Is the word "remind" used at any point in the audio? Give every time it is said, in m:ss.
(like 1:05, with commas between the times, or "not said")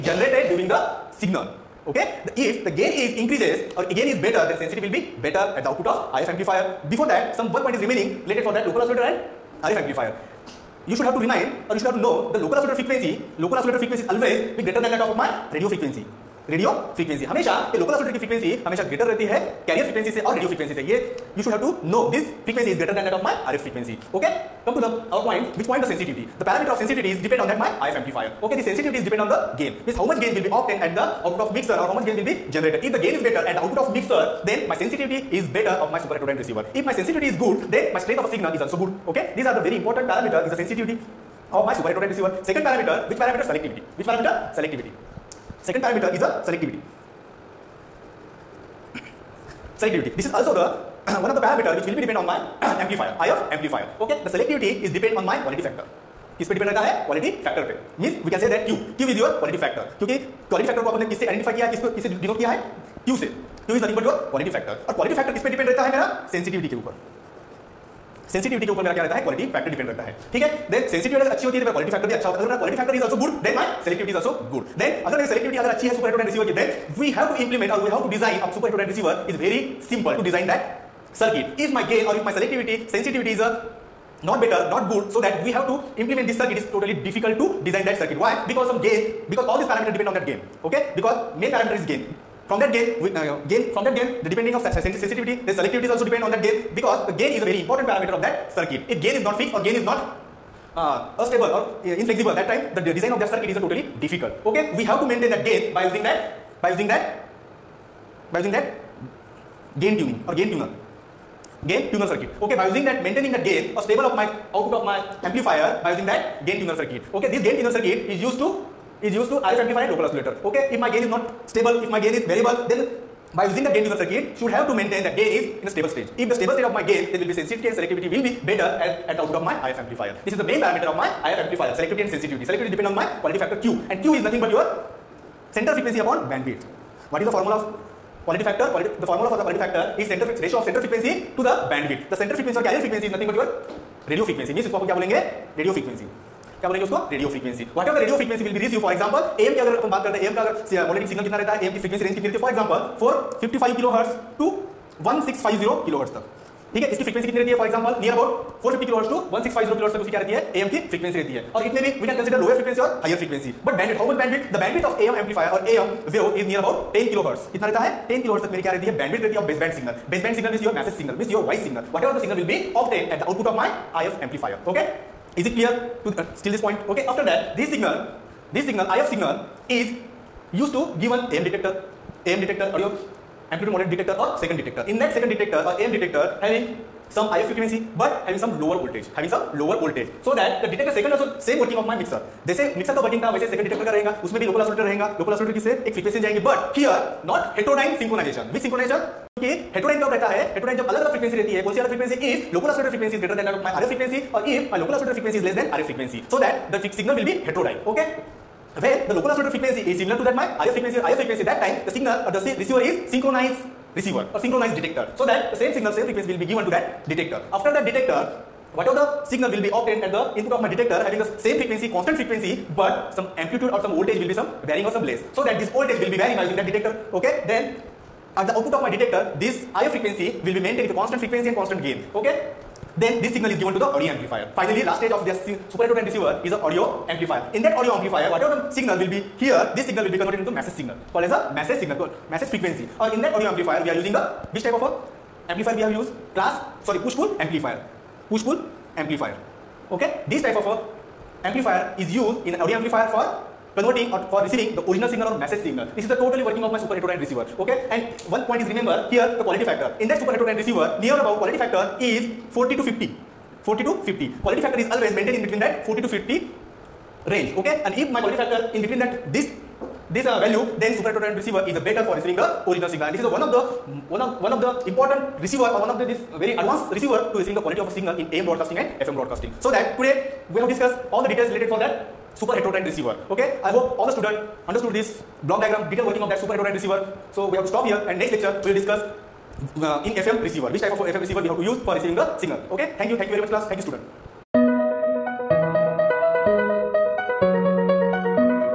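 0:11.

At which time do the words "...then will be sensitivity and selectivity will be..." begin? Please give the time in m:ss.
2:07.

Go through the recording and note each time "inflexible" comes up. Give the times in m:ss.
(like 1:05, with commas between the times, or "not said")
1:42.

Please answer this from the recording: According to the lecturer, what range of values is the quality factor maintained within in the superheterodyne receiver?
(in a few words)
40 to 50.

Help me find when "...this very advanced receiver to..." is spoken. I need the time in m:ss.
4:36.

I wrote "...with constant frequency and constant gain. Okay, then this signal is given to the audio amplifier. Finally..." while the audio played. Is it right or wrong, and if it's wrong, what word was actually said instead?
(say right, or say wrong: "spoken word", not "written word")
right.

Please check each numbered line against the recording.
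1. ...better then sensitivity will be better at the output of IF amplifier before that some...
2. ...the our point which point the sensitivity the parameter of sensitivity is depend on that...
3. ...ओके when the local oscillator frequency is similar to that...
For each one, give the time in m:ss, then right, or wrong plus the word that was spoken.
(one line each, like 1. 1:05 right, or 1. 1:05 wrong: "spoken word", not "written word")
1. 0:04 right
2. 0:24 right
3. 3:27 right.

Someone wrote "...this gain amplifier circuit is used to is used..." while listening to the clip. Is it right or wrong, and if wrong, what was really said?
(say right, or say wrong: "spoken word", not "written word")
wrong: "tuner", not "amplifier".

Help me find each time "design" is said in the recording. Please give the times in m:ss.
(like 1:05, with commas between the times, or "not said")
1:27, 1:42.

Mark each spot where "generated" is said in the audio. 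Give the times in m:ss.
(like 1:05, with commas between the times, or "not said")
0:00, 0:32.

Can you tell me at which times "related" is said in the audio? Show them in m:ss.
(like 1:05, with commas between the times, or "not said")
0:08, 4:41.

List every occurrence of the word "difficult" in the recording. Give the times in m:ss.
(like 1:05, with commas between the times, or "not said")
1:27, 1:44.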